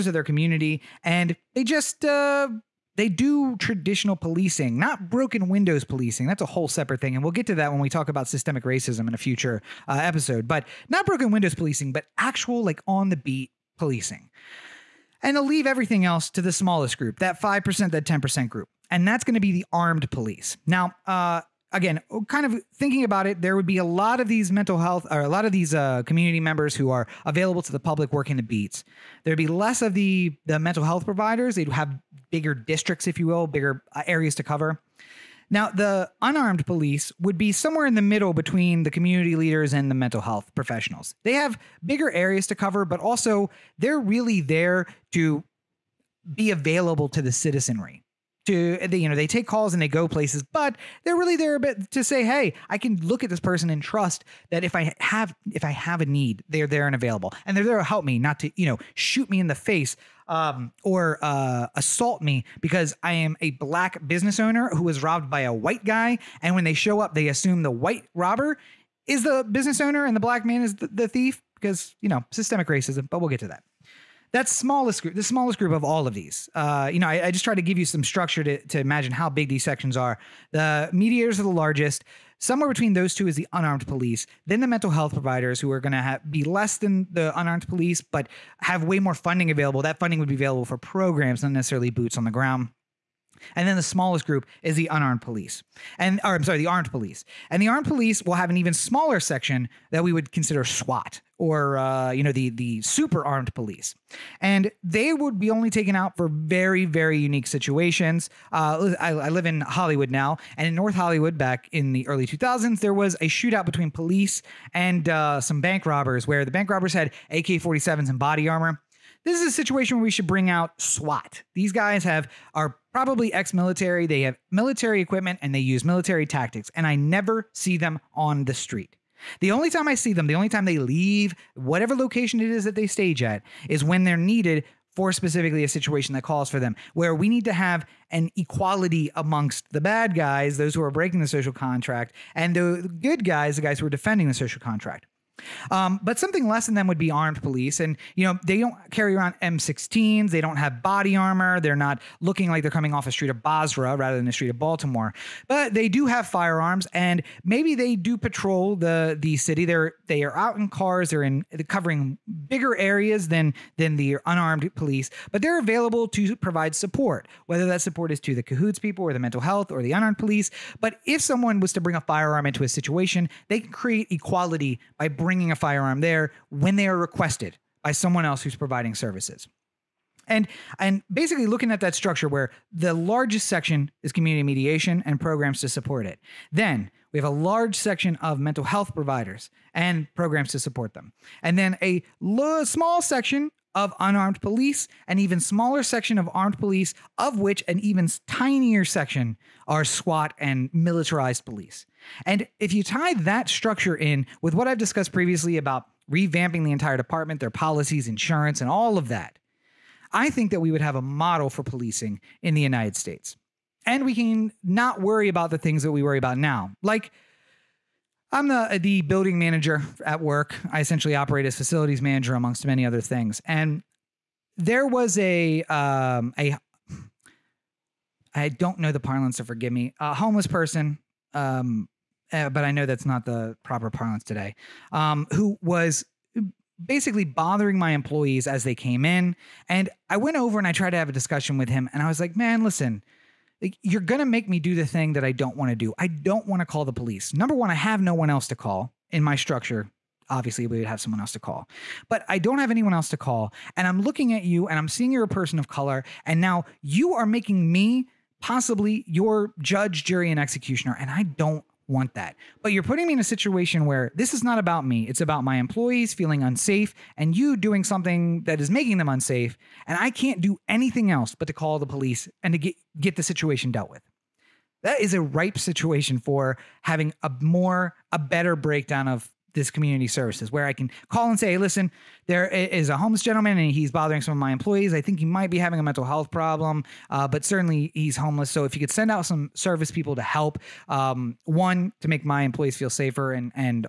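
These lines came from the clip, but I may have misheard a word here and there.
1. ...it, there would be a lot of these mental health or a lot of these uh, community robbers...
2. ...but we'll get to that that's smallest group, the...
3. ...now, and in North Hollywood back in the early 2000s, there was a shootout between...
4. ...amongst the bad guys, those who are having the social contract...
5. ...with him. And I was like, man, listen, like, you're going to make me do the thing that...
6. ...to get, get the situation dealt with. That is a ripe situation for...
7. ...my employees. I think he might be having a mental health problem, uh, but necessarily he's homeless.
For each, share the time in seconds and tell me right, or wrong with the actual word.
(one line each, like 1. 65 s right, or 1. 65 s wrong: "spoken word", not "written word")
1. 23 s wrong: "members", not "robbers"
2. 73 s right
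3. 110 s right
4. 139 s wrong: "breaking", not "having"
5. 241 s right
6. 272 s right
7. 284 s wrong: "certainly", not "necessarily".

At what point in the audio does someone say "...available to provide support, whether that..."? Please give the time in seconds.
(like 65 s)
165 s.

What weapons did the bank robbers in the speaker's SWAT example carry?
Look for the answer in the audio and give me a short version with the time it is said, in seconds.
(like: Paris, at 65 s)
AK-47s, at 117 s.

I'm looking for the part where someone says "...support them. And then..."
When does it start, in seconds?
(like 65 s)
190 s.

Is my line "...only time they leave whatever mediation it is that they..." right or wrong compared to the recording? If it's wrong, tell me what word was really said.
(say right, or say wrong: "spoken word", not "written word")
wrong: "location", not "mediation".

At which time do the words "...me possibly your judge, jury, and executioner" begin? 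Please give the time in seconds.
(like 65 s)
257 s.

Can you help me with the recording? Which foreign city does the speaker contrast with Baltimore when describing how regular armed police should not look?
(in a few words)
Basra.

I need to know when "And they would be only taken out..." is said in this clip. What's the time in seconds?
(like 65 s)
104 s.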